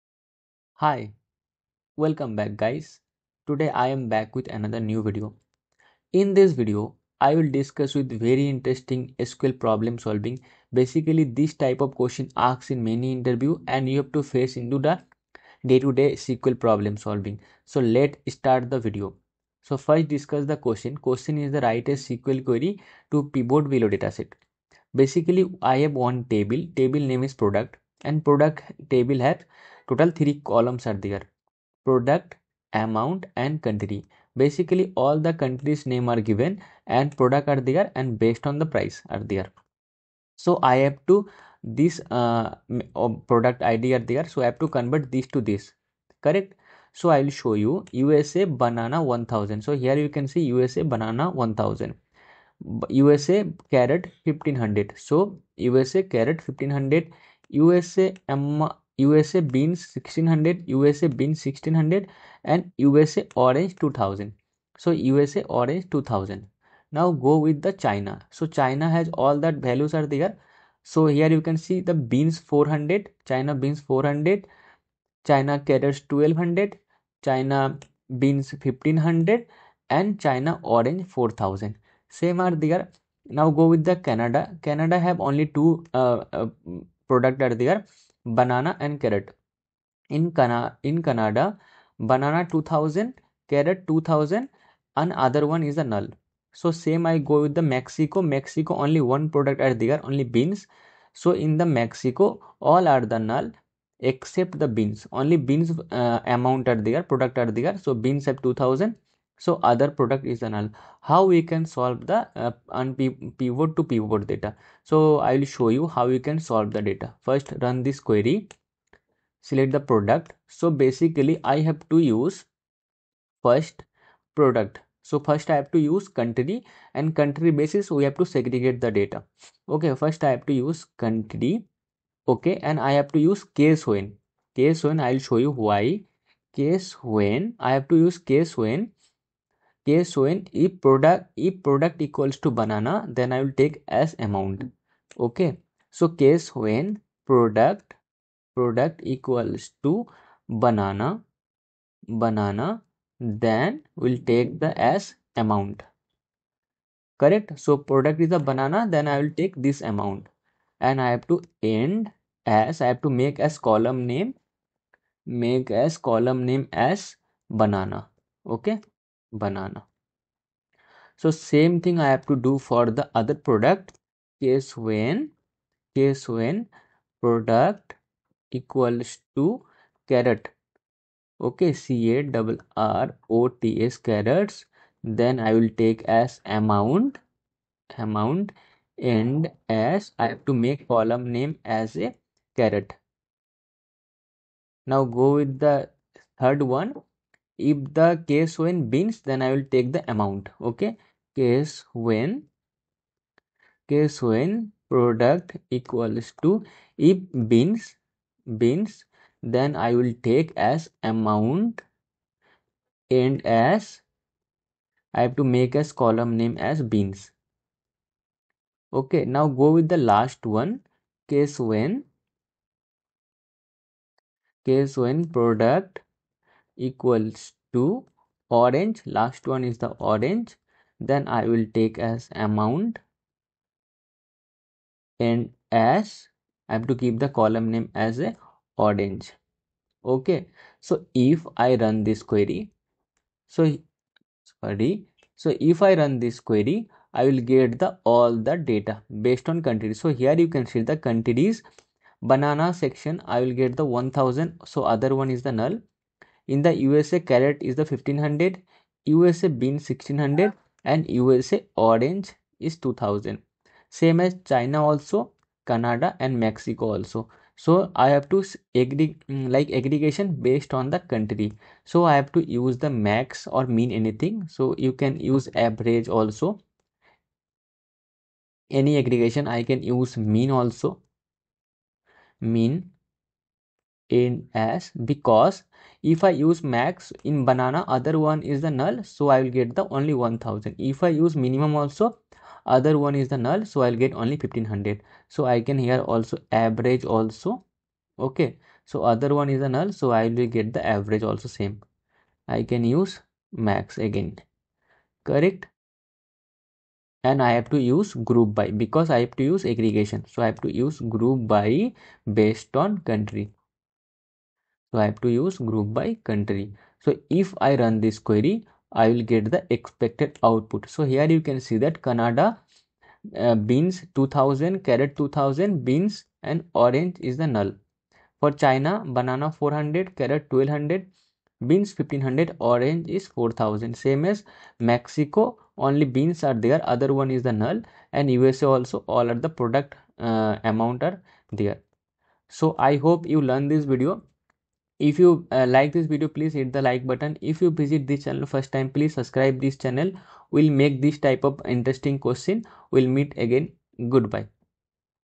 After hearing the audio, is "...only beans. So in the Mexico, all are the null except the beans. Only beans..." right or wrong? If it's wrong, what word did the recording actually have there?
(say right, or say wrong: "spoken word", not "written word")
right.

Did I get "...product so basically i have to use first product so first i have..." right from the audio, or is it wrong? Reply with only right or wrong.
right.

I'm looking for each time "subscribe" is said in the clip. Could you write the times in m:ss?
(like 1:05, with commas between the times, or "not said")
5:49.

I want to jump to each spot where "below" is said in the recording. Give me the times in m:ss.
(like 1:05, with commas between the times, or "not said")
0:23.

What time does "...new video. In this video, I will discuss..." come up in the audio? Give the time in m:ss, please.
0:04.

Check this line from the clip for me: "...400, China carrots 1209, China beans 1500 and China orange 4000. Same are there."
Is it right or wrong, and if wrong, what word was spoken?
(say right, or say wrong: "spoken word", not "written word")
wrong: "1200", not "1209".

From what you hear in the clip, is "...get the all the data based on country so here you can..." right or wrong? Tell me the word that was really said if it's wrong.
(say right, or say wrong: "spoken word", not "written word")
right.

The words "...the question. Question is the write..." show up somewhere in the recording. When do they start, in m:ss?
0:20.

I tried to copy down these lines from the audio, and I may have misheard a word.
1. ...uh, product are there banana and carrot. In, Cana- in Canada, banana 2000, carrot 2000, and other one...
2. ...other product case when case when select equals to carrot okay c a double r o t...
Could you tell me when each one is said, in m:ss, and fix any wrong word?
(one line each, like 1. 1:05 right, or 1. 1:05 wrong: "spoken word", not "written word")
1. 1:26 right
2. 2:53 wrong: "product", not "select".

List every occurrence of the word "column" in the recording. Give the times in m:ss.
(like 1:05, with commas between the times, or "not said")
0:30, 3:10, 3:36, 3:57.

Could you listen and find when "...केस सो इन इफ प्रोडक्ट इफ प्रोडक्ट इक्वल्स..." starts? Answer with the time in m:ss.
2:19.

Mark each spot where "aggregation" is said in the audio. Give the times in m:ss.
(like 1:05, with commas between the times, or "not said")
4:29, 4:38, 5:09.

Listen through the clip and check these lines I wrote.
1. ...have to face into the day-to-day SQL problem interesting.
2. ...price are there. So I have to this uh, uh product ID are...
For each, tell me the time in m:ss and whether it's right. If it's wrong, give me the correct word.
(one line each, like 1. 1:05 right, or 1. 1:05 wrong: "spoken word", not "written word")
1. 0:13 wrong: "solving", not "interesting"
2. 0:38 right.